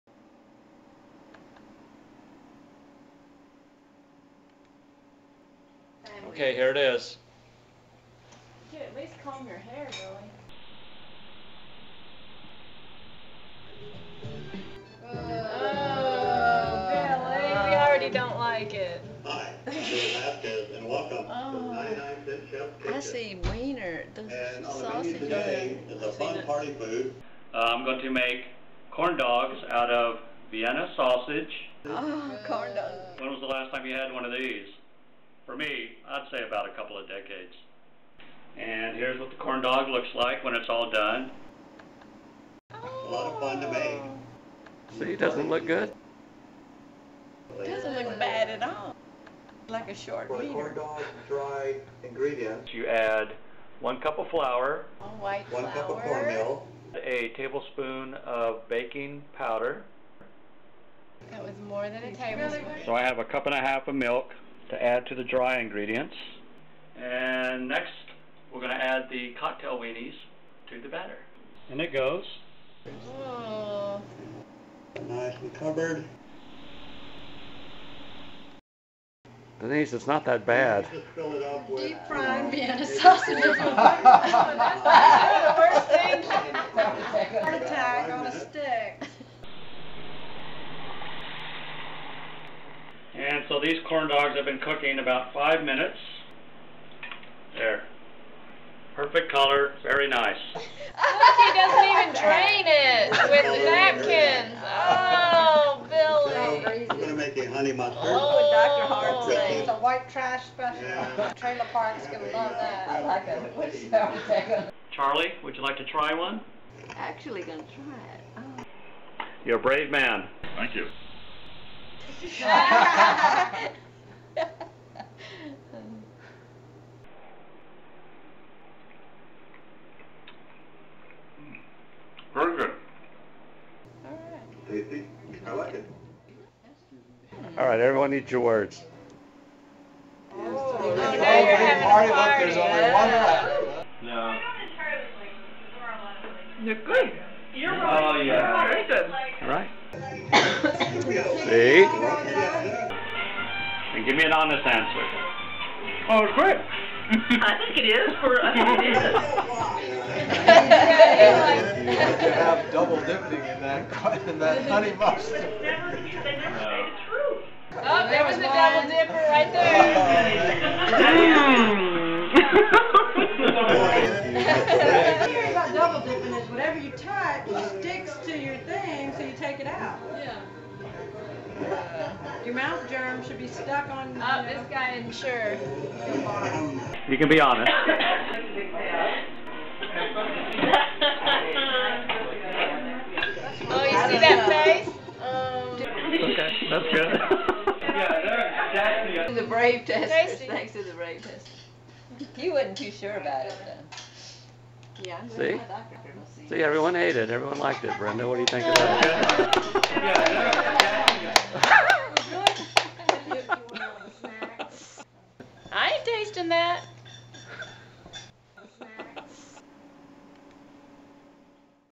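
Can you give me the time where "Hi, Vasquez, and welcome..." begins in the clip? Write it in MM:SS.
00:19.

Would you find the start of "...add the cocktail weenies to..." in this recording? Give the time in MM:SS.
01:08.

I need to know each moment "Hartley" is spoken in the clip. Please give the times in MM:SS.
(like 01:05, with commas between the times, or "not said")
01:48.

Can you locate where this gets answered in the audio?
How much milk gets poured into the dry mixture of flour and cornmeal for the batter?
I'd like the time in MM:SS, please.
01:03.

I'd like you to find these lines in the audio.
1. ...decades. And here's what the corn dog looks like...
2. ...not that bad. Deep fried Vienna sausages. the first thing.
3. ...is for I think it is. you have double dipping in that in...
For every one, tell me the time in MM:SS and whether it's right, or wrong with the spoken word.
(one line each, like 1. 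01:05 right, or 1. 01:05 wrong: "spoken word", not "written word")
1. 00:37 right
2. 01:20 right
3. 02:37 right.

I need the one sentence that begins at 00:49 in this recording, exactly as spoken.
Like a short for corn dog, dry ingredients.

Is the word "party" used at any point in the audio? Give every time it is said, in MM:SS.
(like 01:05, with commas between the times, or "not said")
00:26, 02:21.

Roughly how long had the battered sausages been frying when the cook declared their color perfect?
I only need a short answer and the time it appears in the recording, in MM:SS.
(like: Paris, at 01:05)
5 minutes, at 01:34.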